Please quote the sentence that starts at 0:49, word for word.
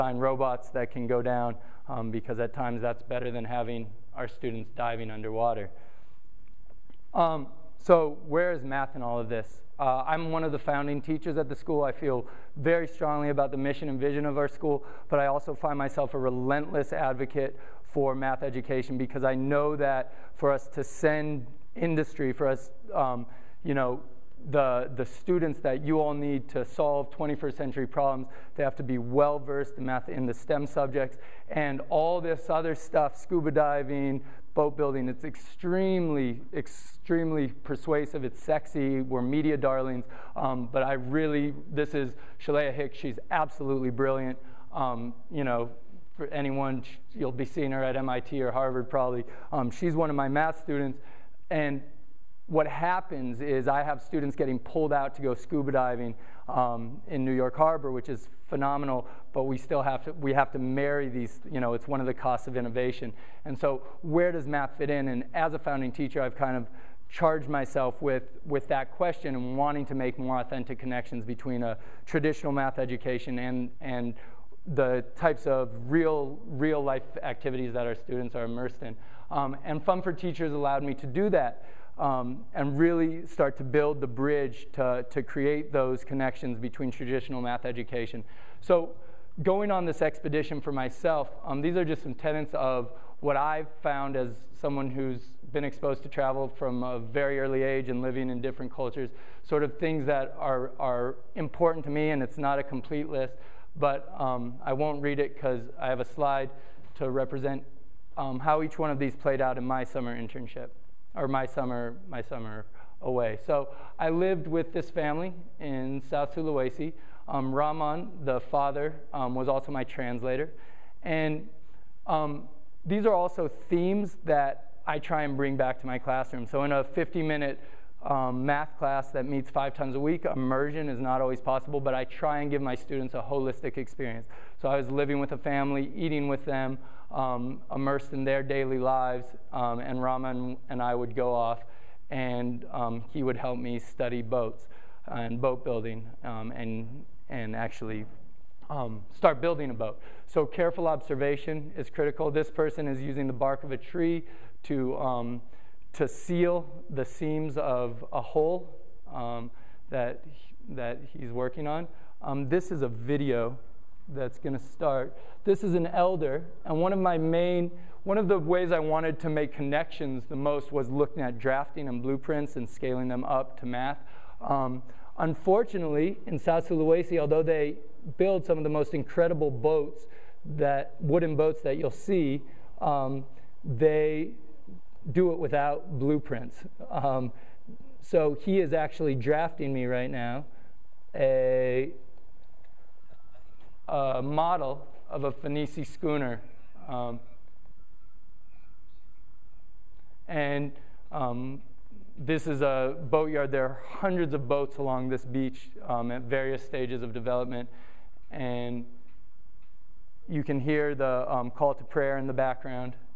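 Um, she's one of my math students.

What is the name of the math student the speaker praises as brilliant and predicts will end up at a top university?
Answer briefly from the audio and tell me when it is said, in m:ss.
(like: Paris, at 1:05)
Shalea Hicks, at 0:42.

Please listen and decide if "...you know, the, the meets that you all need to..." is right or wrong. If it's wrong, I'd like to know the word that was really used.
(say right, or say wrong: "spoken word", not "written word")
wrong: "students", not "meets".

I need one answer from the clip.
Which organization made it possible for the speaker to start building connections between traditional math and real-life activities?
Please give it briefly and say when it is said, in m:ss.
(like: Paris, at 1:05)
Fund for Teachers, at 1:19.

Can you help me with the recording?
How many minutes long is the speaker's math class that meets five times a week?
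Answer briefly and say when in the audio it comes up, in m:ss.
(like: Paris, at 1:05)
50, at 2:06.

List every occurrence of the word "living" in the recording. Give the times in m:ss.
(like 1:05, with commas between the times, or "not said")
1:38, 2:14.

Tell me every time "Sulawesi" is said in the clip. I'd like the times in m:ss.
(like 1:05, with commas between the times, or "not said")
1:56, 2:56.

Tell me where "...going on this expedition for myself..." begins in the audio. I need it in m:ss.
1:29.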